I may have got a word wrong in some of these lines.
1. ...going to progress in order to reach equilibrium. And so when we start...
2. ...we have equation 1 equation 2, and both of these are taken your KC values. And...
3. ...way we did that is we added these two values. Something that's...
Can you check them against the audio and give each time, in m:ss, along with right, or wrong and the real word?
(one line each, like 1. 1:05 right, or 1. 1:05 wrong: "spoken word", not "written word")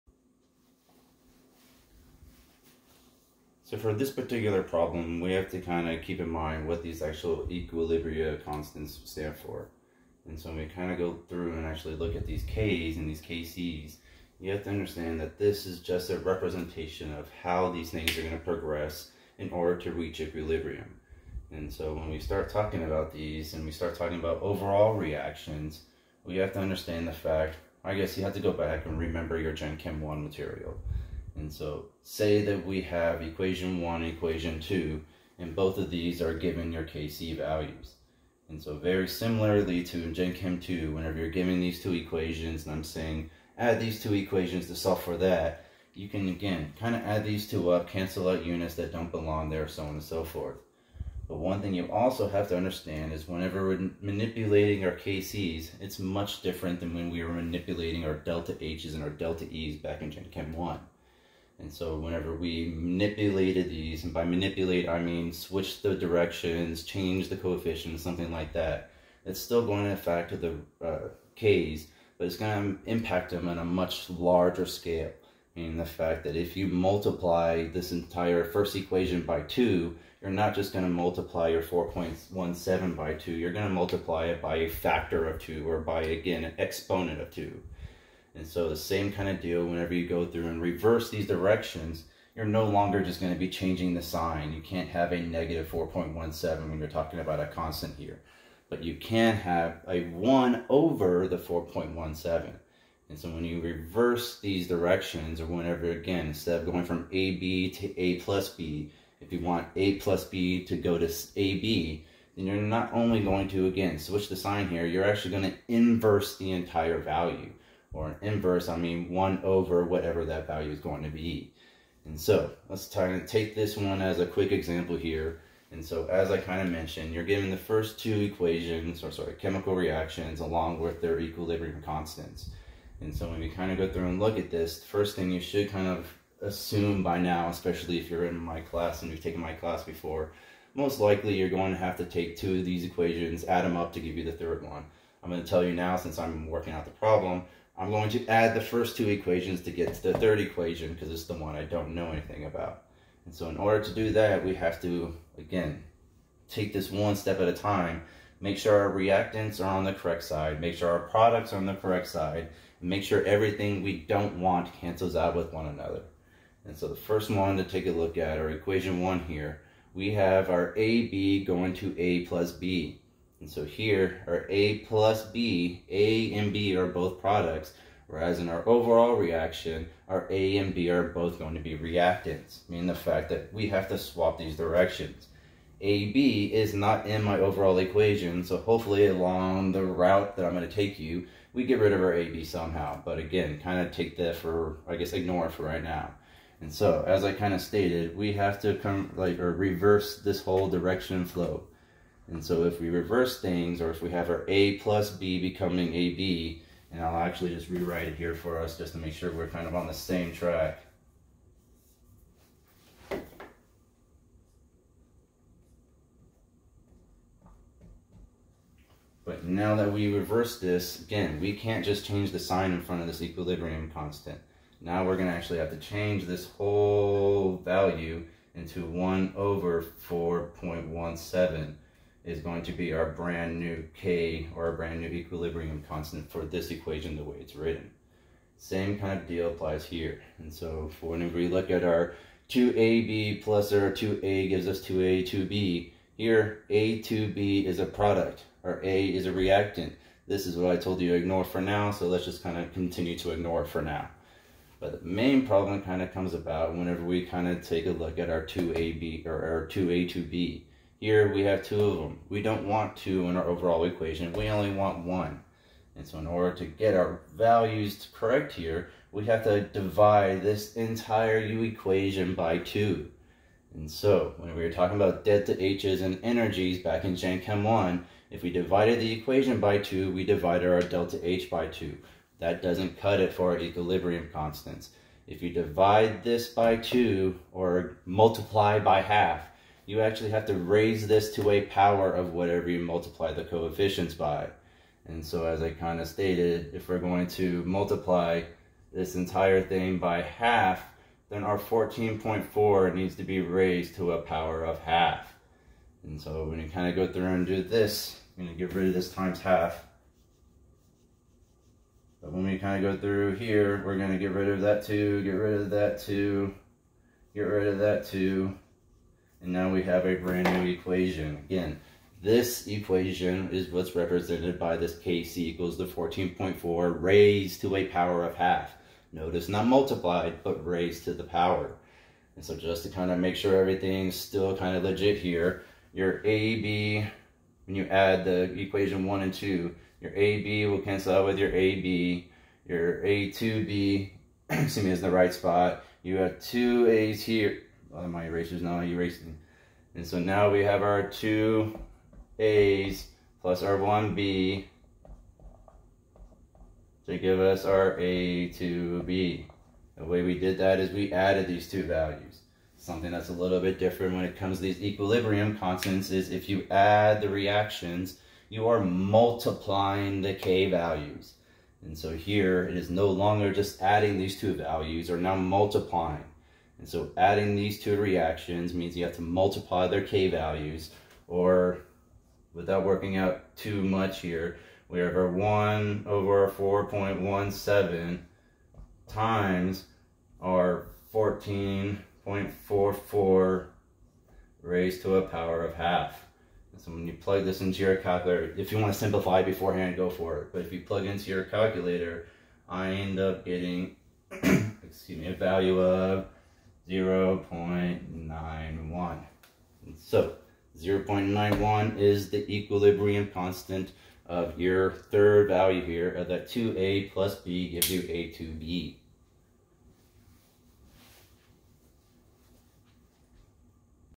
1. 0:18 right
2. 0:32 wrong: "given", not "taken"
3. 6:00 right.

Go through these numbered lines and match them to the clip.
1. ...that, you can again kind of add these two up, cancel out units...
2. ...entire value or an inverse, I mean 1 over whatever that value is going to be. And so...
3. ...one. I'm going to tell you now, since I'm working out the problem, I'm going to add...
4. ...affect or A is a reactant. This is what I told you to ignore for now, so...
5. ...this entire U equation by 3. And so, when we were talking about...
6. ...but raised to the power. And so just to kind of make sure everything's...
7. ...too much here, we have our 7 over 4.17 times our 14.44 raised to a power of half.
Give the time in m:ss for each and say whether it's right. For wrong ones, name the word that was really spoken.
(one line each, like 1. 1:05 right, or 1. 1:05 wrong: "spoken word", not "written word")
1. 0:45 right
2. 1:56 right
3. 2:24 right
4. 4:07 wrong: "product", not "affect"
5. 4:30 wrong: "2", not "3"
6. 5:30 right
7. 6:23 wrong: "1", not "7".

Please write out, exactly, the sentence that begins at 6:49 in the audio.
So 0 0.91 is the equilibrium constant of your third value here of that 2a plus b gives you a2b.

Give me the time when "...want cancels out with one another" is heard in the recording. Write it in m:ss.
2:44.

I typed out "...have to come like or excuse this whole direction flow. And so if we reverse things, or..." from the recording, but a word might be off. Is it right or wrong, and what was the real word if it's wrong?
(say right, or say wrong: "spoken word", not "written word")
wrong: "reverse", not "excuse".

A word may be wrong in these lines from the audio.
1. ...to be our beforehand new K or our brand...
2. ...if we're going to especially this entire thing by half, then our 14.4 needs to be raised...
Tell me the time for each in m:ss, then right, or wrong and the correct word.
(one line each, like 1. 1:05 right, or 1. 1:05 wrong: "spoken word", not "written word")
1. 3:52 wrong: "brand", not "beforehand"
2. 4:56 wrong: "multiply", not "especially".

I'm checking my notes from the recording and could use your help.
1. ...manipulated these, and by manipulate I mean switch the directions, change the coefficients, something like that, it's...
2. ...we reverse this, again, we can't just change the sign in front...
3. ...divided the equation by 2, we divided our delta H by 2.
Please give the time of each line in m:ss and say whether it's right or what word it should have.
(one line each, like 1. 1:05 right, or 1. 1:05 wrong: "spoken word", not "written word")
1. 1:02 right
2. 3:39 right
3. 4:38 right.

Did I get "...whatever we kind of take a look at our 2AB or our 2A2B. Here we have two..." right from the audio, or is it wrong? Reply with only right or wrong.
wrong.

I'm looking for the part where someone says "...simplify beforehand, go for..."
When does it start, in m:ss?
6:38.